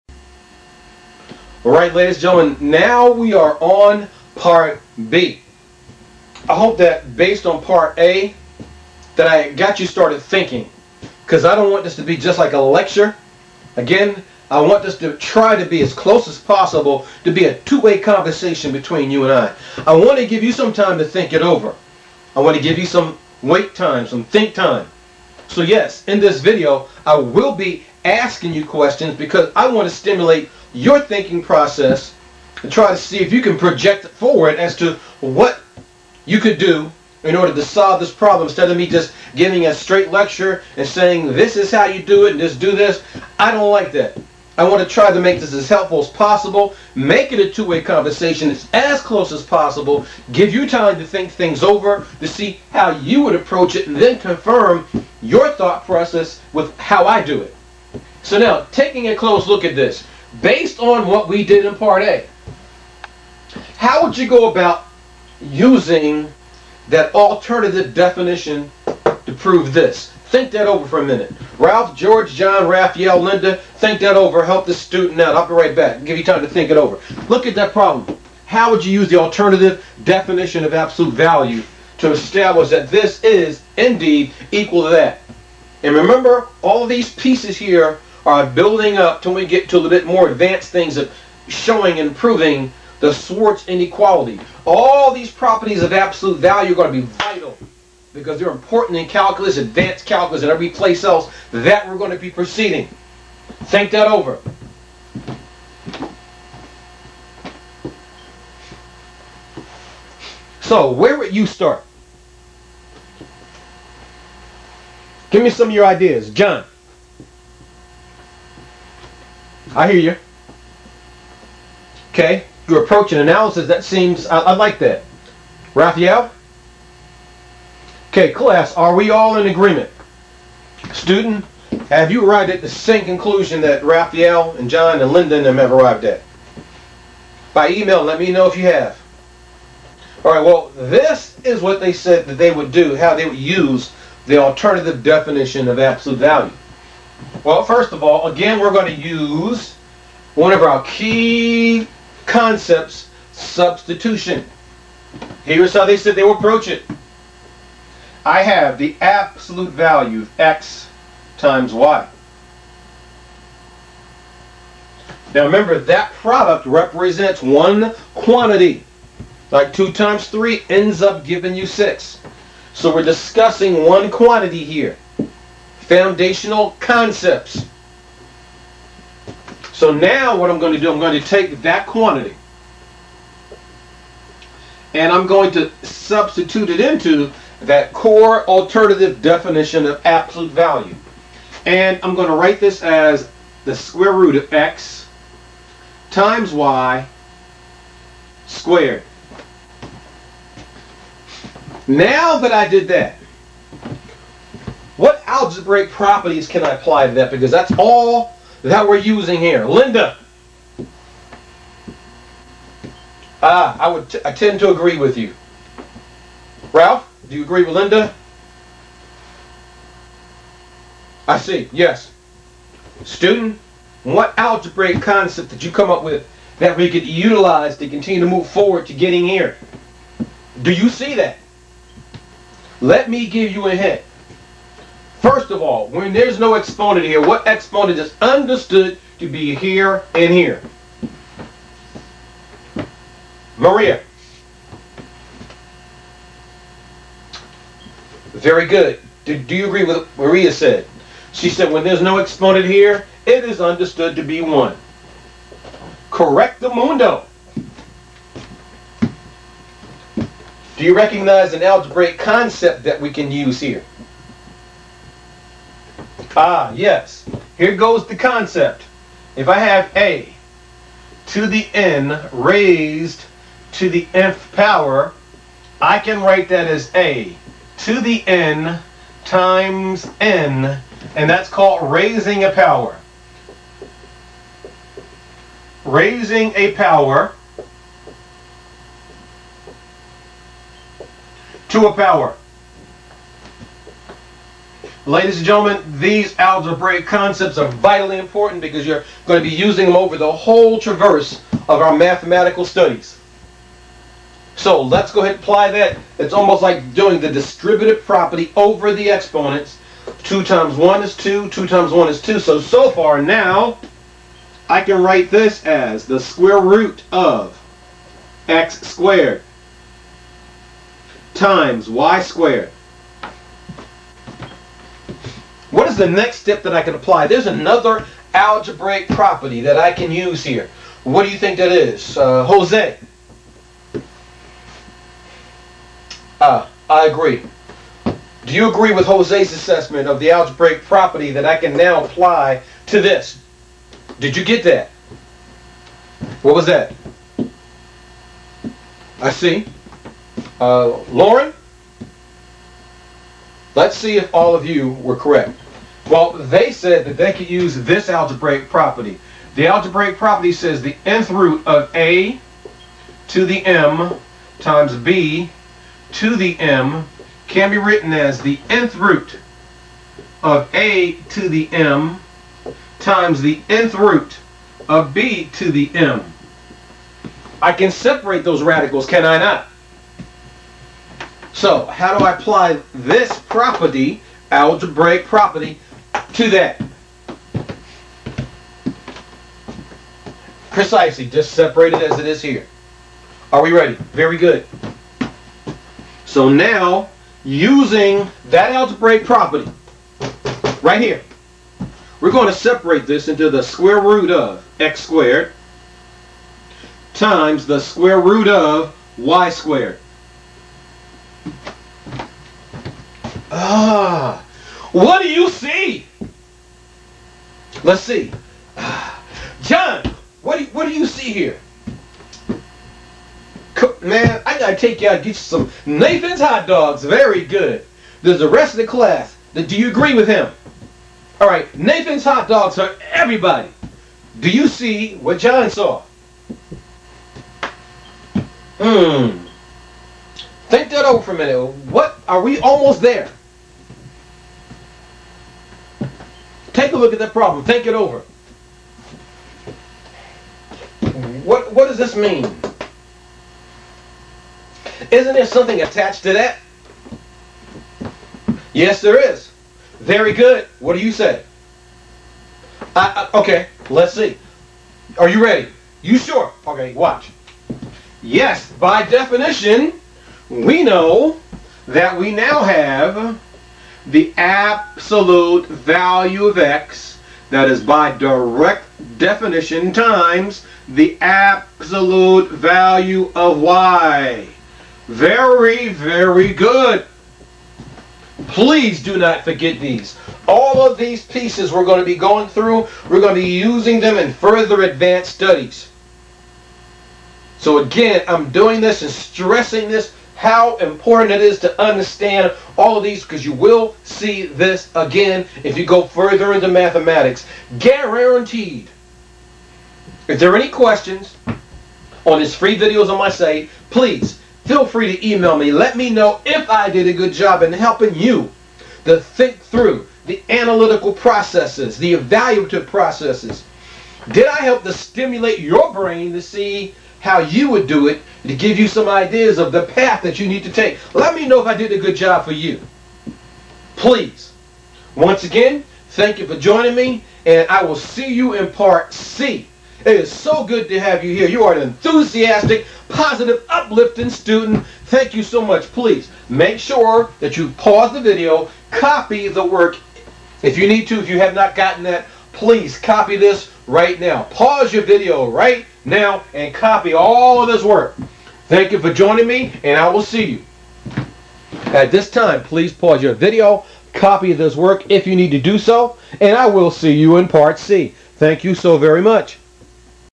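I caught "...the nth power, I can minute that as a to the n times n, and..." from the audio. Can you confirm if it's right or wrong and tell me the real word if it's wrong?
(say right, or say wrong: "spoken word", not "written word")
wrong: "write", not "minute".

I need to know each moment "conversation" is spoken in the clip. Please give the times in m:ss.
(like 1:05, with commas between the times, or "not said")
0:17, 0:47.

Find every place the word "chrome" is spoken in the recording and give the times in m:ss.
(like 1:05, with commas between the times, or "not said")
not said.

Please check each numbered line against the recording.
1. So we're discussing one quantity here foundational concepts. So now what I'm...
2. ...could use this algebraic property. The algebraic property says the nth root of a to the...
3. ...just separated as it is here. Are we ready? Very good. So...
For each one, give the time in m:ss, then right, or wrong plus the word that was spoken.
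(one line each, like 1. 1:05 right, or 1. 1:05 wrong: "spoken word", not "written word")
1. 2:52 right
2. 5:57 right
3. 6:31 right.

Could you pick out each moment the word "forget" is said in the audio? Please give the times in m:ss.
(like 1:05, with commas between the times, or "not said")
8:09.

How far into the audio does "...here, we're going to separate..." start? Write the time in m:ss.
6:41.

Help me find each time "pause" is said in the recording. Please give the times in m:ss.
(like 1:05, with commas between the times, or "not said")
9:07, 9:14, 9:22.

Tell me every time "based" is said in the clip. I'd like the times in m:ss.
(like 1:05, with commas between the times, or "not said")
0:07, 1:00.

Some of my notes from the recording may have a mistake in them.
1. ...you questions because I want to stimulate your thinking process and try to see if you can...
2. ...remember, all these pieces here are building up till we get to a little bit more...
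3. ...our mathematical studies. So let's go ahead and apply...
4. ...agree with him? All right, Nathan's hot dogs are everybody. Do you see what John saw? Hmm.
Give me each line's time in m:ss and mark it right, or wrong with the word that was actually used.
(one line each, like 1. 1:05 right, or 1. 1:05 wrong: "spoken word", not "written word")
1. 0:28 right
2. 1:25 right
3. 5:01 right
4. 7:09 right.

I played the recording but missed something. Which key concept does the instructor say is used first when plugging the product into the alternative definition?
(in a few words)
substitution.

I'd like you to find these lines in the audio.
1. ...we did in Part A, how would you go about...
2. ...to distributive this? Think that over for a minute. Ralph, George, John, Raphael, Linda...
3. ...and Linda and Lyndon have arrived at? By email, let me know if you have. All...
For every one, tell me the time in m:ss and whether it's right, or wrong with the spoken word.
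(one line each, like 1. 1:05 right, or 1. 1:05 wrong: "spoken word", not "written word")
1. 1:01 right
2. 1:08 wrong: "prove", not "distributive"
3. 2:14 wrong: "John", not "Linda".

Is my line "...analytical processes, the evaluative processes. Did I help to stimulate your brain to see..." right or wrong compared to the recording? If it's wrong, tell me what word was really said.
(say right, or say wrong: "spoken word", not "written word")
right.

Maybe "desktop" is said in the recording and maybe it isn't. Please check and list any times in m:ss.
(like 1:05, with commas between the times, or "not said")
not said.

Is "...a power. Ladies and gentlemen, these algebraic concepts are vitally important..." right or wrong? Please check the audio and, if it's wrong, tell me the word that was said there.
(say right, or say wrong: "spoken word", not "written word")
right.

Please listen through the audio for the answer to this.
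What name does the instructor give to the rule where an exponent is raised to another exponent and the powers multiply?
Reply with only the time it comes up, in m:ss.
4:45.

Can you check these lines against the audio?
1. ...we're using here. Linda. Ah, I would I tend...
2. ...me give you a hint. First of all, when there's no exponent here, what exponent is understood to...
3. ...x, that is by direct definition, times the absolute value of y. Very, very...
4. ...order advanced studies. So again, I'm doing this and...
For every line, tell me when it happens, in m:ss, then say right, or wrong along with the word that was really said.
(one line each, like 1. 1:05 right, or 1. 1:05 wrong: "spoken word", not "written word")
1. 3:28 right
2. 3:53 right
3. 7:56 right
4. 8:14 wrong: "further", not "order".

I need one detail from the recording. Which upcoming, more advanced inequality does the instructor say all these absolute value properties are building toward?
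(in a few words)
Schwarz inequality.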